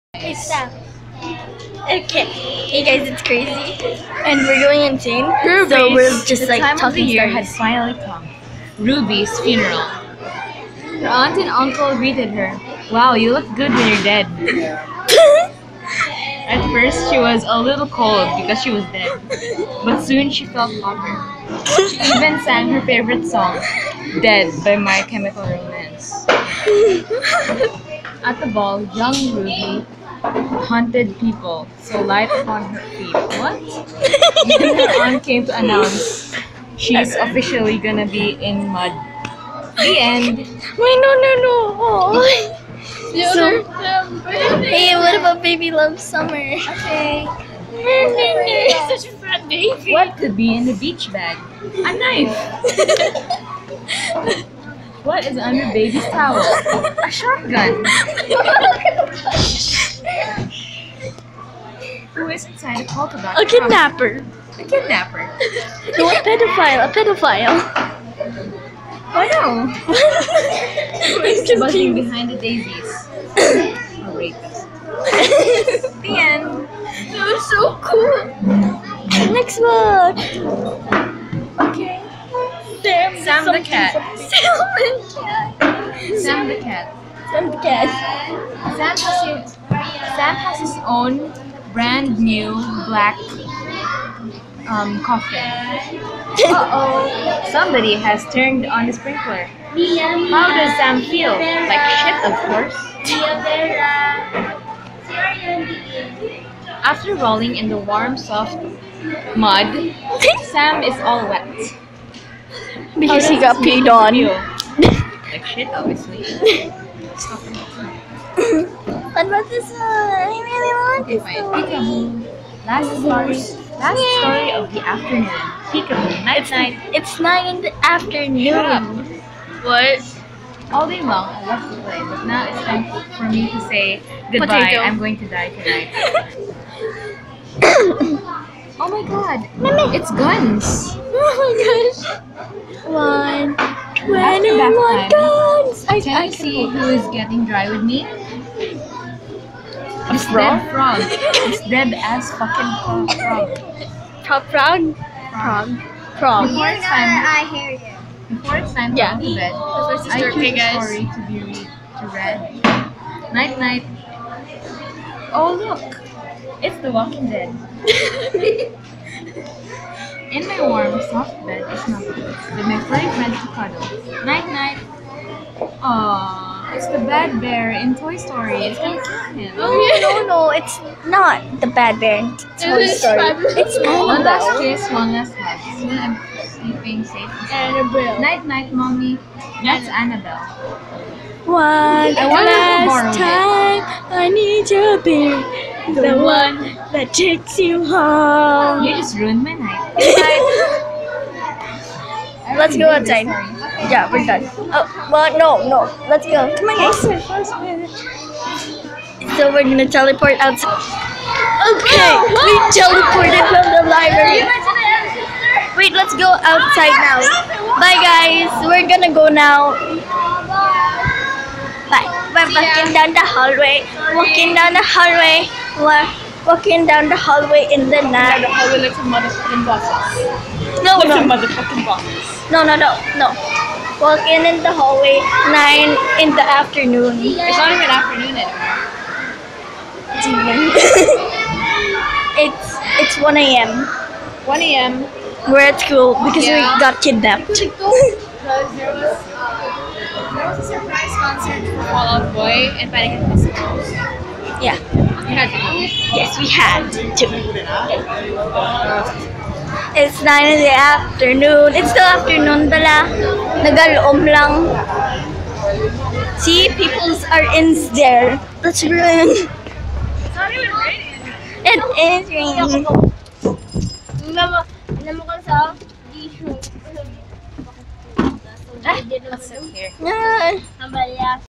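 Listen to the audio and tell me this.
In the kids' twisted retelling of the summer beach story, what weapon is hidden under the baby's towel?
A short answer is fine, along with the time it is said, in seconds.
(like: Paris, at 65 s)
A shotgun, at 57 s.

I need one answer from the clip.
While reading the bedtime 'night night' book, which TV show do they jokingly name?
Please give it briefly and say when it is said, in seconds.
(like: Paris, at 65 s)
The Walking Dead, at 166 s.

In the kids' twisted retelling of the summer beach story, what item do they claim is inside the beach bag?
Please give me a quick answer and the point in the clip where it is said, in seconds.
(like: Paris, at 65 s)
A knife, at 51 s.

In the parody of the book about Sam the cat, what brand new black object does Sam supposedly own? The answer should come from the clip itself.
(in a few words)
Coffin.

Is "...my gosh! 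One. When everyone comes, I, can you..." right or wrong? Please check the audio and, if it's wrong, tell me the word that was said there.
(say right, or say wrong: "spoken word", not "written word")
right.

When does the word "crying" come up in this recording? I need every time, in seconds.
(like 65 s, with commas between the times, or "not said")
not said.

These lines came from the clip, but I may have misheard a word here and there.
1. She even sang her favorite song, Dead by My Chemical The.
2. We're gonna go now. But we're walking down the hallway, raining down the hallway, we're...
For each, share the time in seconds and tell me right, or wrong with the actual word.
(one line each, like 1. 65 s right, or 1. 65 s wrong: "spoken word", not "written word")
1. 21 s wrong: "Romance", not "The"
2. 218 s wrong: "walking", not "raining".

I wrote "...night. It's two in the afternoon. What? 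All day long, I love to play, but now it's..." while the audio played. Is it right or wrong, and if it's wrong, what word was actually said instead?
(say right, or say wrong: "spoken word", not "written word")
wrong: "nine", not "two".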